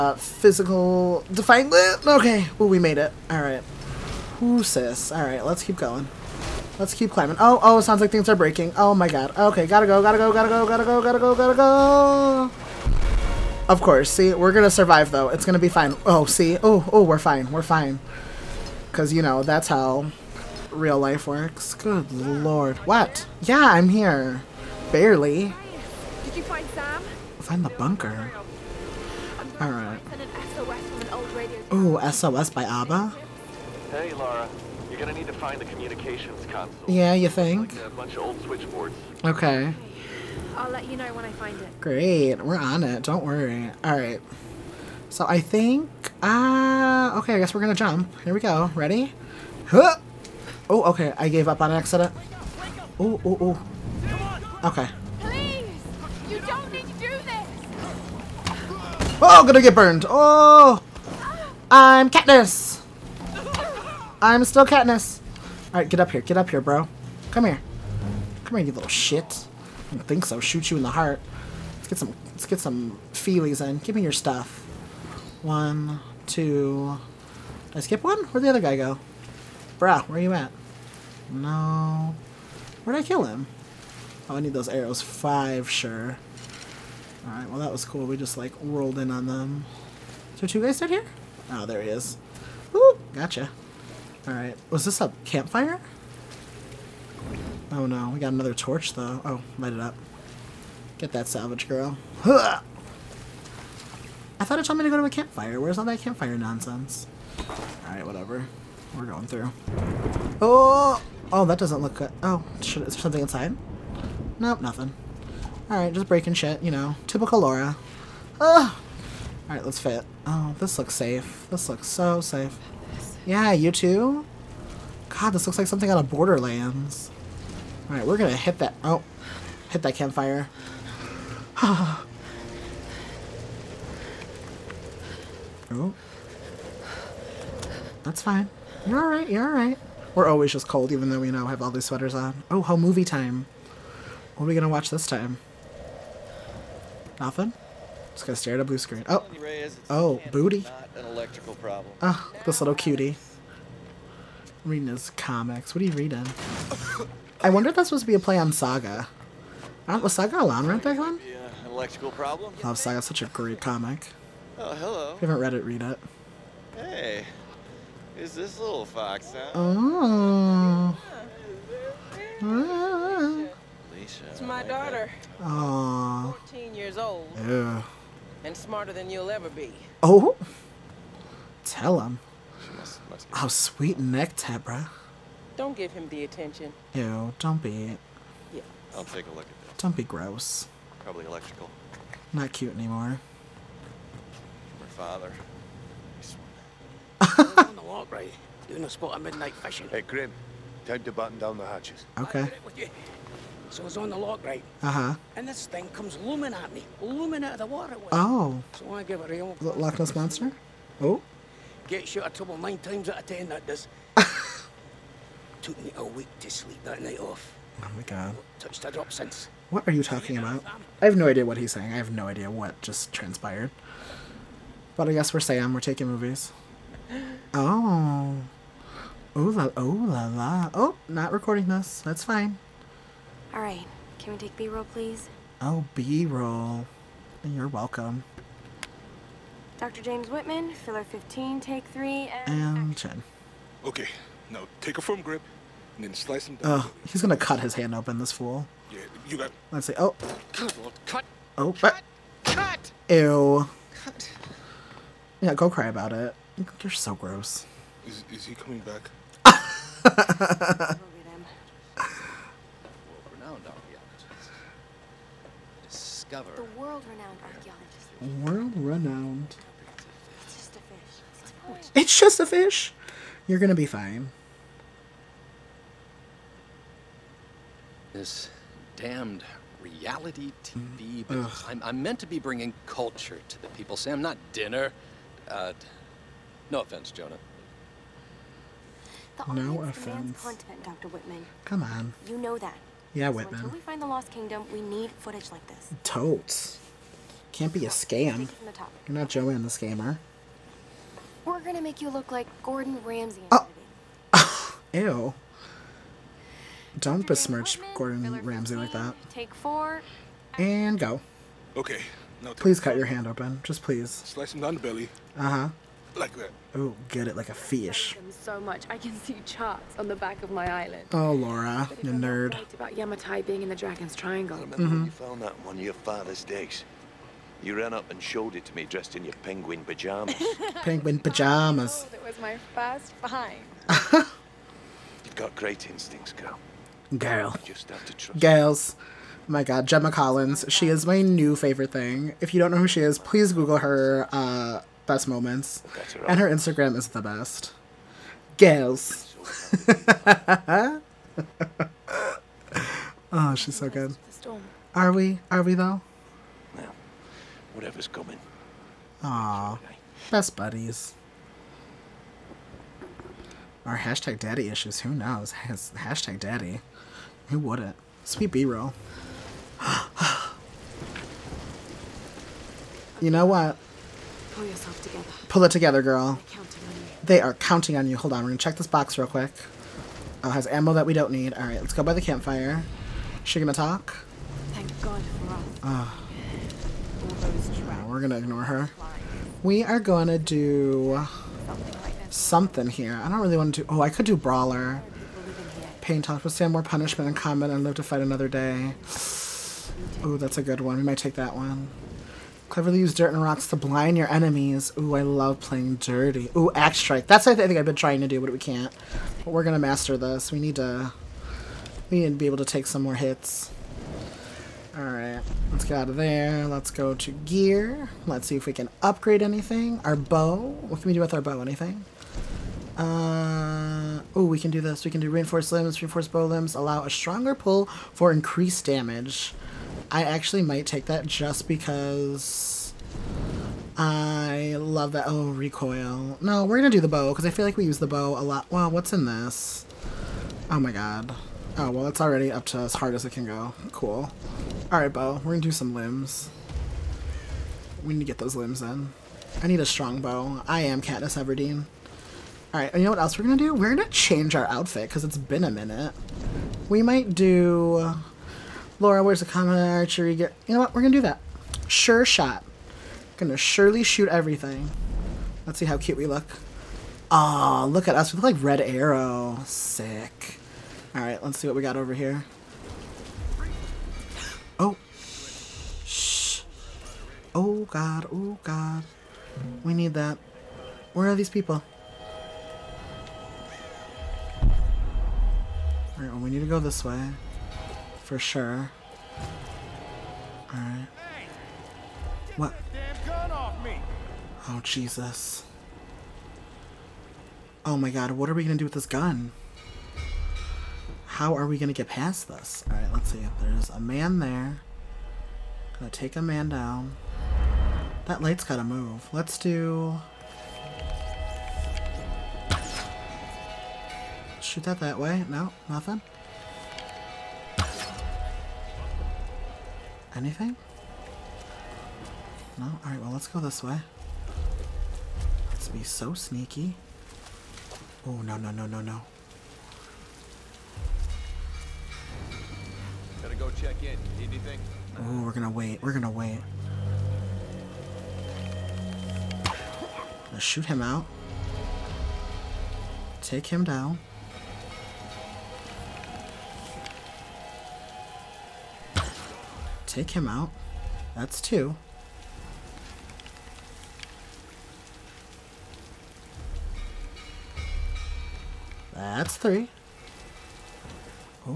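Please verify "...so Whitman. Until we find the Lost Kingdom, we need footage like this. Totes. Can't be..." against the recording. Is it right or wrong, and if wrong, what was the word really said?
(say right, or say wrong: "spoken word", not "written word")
right.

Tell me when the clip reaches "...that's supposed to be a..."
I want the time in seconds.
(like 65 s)
157 s.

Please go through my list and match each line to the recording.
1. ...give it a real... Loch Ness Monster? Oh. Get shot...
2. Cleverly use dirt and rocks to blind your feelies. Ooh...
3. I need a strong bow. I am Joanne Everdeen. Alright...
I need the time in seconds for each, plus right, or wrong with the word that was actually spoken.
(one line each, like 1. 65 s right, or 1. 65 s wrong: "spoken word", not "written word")
1. 209 s right
2. 402 s wrong: "enemies", not "feelies"
3. 449 s wrong: "Katniss", not "Joanne".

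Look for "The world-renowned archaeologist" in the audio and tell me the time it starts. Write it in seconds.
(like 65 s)
266 s.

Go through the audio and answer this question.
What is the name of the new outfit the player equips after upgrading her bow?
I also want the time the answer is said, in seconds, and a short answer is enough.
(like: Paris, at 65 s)
Sure Shot, at 461 s.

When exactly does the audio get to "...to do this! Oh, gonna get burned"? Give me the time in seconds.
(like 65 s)
56 s.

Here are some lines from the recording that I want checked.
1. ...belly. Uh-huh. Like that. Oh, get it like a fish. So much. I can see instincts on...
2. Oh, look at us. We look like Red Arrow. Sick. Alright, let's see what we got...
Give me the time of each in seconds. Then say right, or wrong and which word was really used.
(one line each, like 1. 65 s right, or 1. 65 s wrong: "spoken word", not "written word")
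1. 314 s wrong: "charts", not "instincts"
2. 467 s right.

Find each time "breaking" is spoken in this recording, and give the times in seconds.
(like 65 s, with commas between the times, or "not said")
8 s, 116 s.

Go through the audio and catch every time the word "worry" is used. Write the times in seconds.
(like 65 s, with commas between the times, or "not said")
43 s.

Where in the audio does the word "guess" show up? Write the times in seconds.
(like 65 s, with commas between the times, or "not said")
47 s, 225 s.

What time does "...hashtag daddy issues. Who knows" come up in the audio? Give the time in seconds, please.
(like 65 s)
363 s.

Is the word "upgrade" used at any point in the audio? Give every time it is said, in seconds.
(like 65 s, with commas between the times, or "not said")
419 s.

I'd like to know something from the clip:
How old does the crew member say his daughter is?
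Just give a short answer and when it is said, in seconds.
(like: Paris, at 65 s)
14, at 176 s.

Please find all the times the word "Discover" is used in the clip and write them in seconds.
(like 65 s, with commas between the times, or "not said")
265 s.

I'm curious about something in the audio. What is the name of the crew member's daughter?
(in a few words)
Alisha.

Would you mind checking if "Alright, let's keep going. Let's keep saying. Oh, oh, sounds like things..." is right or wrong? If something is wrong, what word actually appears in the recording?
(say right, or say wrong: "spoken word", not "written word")
wrong: "climbing", not "saying".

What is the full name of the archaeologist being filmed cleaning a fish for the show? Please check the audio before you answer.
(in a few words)
James Whitman.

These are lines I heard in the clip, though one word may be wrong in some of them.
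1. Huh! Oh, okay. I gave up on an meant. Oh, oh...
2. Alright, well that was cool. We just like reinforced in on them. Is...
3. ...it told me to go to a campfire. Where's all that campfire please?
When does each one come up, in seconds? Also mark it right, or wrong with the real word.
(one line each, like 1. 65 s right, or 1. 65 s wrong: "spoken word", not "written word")
1. 49 s wrong: "accident", not "meant"
2. 87 s wrong: "rolled", not "reinforced"
3. 104 s wrong: "nonsense", not "please".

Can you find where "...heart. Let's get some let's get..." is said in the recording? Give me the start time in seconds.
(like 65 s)
70 s.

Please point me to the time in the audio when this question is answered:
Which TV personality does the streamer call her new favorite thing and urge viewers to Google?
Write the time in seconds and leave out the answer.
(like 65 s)
339 s.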